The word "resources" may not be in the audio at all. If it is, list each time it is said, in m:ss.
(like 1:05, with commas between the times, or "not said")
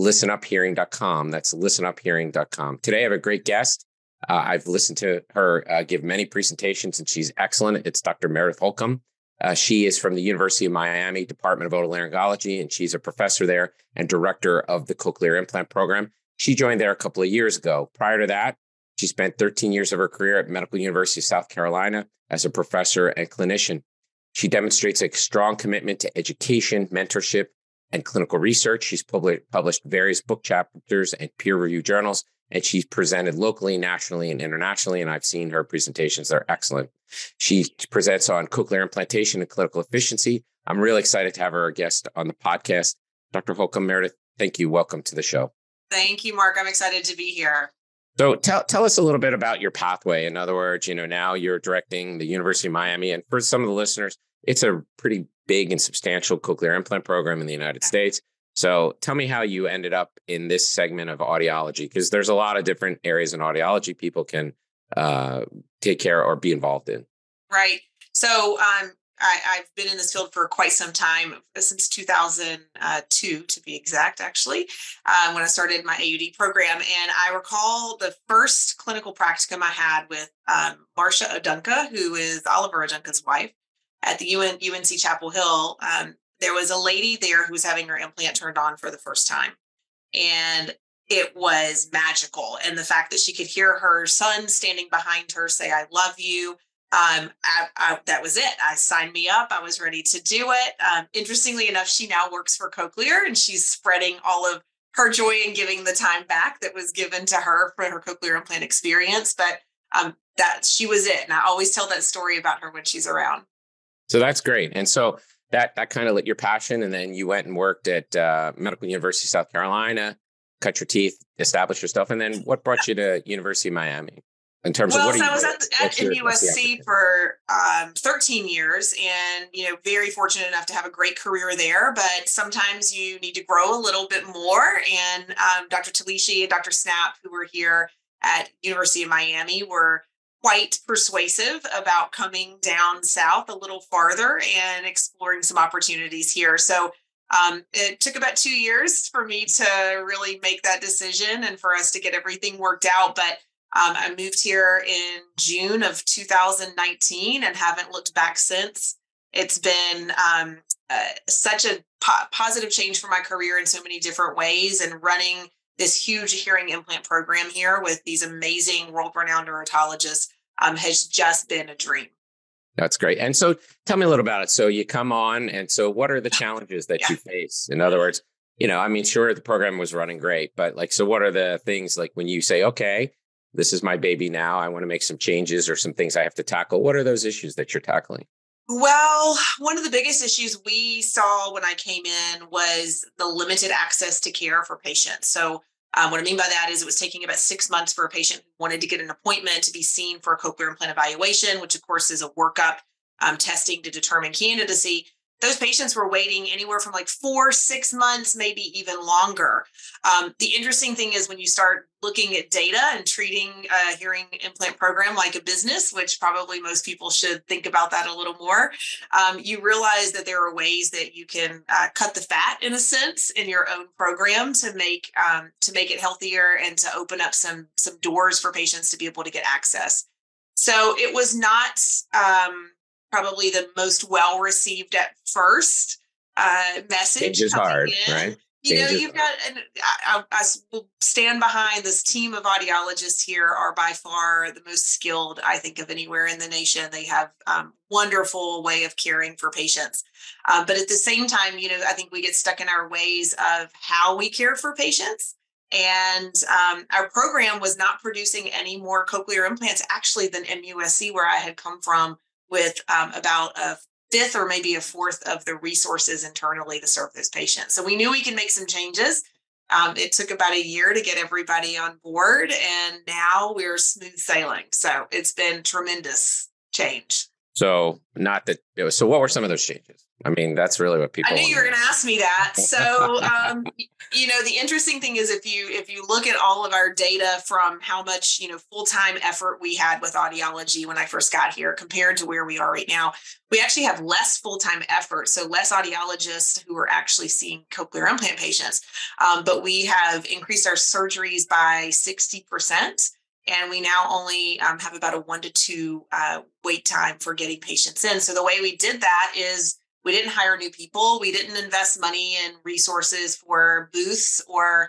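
4:25, 5:12.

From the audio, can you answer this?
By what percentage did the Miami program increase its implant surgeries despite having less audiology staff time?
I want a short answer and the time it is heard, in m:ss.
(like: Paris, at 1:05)
60%, at 5:01.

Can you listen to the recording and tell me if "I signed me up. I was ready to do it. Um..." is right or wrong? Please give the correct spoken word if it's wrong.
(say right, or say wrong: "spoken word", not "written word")
right.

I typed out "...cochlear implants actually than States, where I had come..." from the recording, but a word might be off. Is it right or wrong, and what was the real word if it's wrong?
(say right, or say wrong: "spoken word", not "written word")
wrong: "MUSC", not "States".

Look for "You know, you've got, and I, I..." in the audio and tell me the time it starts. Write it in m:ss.
3:58.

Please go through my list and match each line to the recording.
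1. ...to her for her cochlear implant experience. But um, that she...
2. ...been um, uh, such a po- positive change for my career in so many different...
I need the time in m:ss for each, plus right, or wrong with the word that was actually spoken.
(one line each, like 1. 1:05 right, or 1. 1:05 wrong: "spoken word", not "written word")
1. 1:47 right
2. 2:39 right.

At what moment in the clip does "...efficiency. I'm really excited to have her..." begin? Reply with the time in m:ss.
0:39.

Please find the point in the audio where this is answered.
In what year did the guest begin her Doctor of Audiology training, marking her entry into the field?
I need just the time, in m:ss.
1:11.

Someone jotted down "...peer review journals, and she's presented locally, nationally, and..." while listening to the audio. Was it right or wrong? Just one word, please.
right.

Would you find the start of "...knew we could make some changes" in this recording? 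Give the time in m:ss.
4:27.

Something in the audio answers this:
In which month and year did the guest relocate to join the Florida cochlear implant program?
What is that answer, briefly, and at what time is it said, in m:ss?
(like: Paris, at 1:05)
June 2019, at 2:35.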